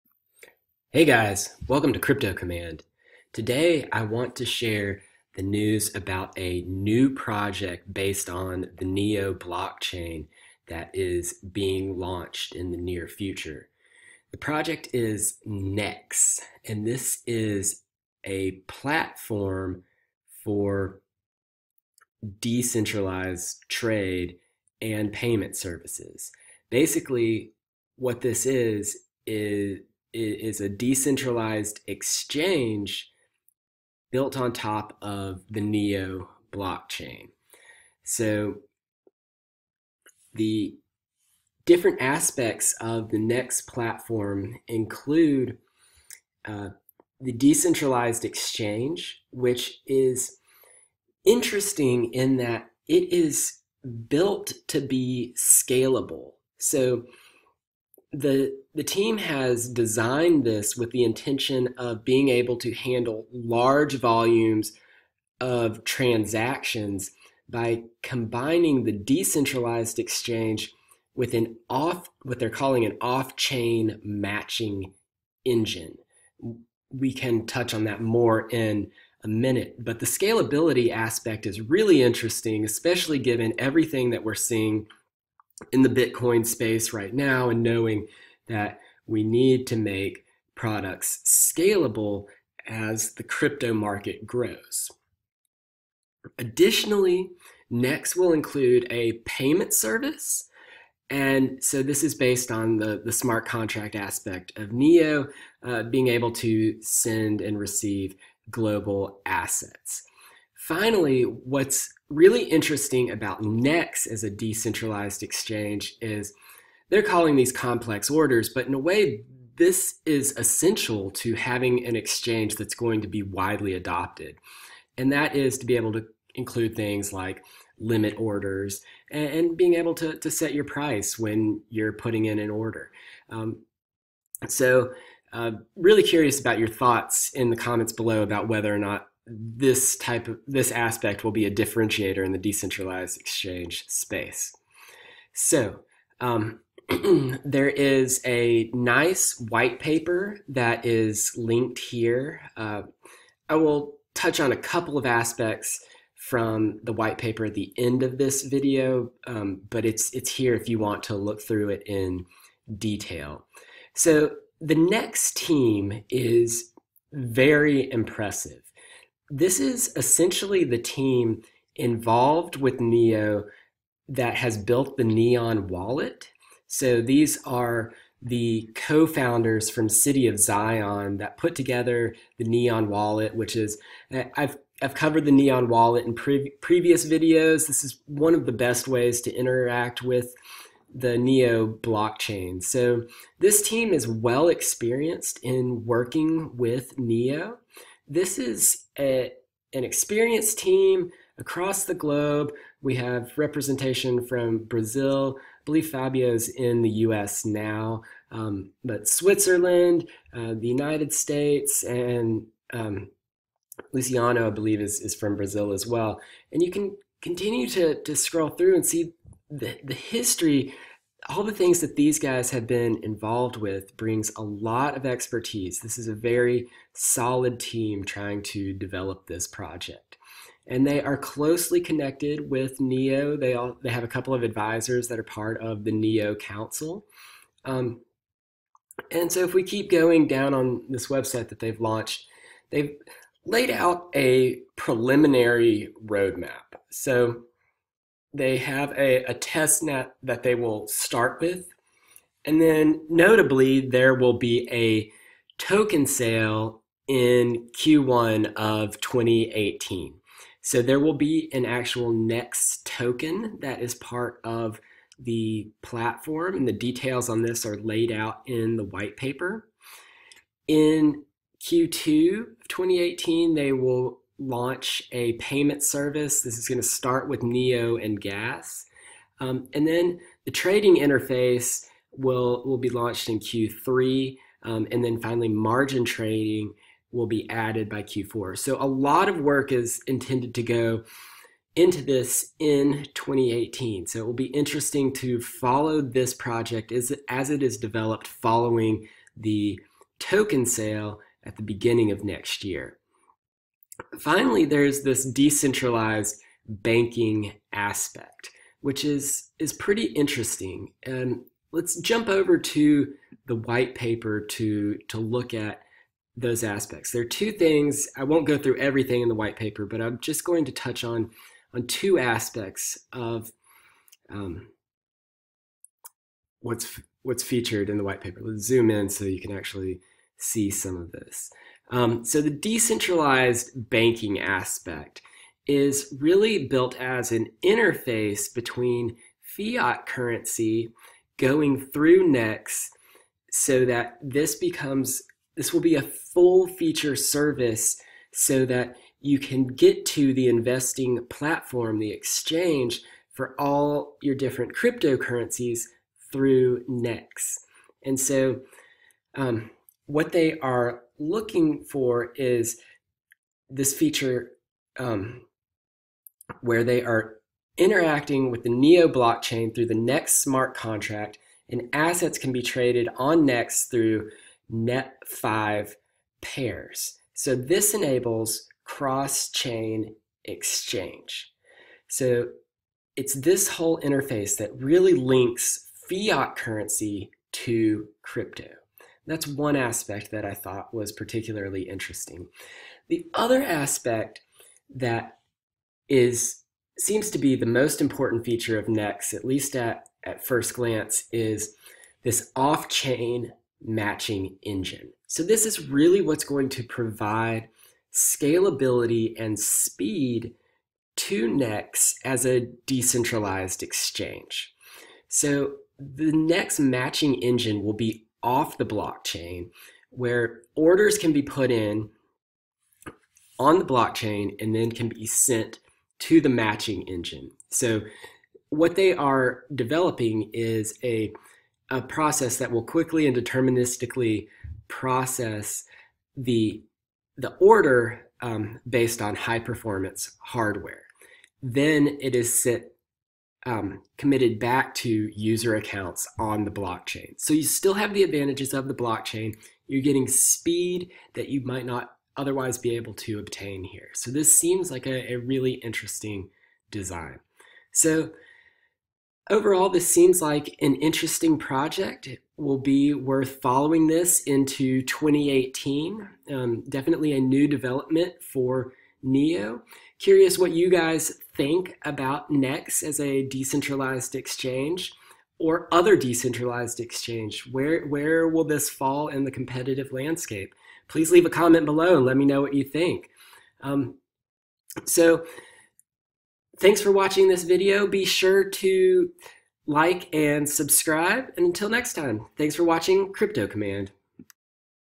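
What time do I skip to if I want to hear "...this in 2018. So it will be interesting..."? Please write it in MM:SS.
04:52.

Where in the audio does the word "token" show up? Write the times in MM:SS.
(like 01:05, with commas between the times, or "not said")
04:15, 04:22, 05:00.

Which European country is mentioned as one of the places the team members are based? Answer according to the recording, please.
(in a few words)
Switzerland.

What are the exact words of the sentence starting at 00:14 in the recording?
The project is NEX, and this is a platform for decentralized trade and payment services.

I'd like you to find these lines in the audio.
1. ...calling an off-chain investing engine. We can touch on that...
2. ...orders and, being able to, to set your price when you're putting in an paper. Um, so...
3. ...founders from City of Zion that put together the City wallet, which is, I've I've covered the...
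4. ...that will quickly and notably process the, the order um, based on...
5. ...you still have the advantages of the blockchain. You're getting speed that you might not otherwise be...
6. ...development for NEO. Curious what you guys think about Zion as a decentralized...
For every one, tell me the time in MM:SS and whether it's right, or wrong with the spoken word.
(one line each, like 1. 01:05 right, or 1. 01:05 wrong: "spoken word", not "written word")
1. 01:12 wrong: "matching", not "investing"
2. 02:08 wrong: "order", not "paper"
3. 02:59 wrong: "Neon", not "City"
4. 07:12 wrong: "deterministically", not "notably"
5. 07:27 right
6. 07:47 wrong: "NEX", not "Zion".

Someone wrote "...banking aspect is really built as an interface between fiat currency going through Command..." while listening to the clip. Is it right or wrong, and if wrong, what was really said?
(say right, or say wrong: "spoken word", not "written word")
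wrong: "Nex", not "Command".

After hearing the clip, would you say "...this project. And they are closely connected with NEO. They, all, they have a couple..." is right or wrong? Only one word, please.
right.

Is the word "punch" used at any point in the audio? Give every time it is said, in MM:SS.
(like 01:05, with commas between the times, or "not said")
not said.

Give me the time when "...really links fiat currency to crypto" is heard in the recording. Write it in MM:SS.
06:24.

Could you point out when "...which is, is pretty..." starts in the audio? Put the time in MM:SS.
05:08.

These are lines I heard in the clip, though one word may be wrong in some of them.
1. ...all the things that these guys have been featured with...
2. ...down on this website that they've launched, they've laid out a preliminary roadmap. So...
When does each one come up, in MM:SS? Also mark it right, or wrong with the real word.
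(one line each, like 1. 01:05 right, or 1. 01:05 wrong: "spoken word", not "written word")
1. 03:41 wrong: "involved", not "featured"
2. 04:00 right.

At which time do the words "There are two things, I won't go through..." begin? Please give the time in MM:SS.
05:17.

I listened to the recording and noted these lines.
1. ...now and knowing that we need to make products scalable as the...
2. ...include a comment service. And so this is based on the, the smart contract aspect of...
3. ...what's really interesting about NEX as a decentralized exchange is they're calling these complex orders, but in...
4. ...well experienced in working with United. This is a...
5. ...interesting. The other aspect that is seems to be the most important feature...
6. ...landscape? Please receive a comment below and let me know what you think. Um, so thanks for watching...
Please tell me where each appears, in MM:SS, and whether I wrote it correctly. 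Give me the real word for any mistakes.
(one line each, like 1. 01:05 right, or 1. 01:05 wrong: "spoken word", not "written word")
1. 01:27 right
2. 01:38 wrong: "payment", not "comment"
3. 01:51 right
4. 03:14 wrong: "Neo", not "United"
5. 06:31 right
6. 08:00 wrong: "leave", not "receive".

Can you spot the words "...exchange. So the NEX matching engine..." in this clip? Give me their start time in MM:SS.
06:53.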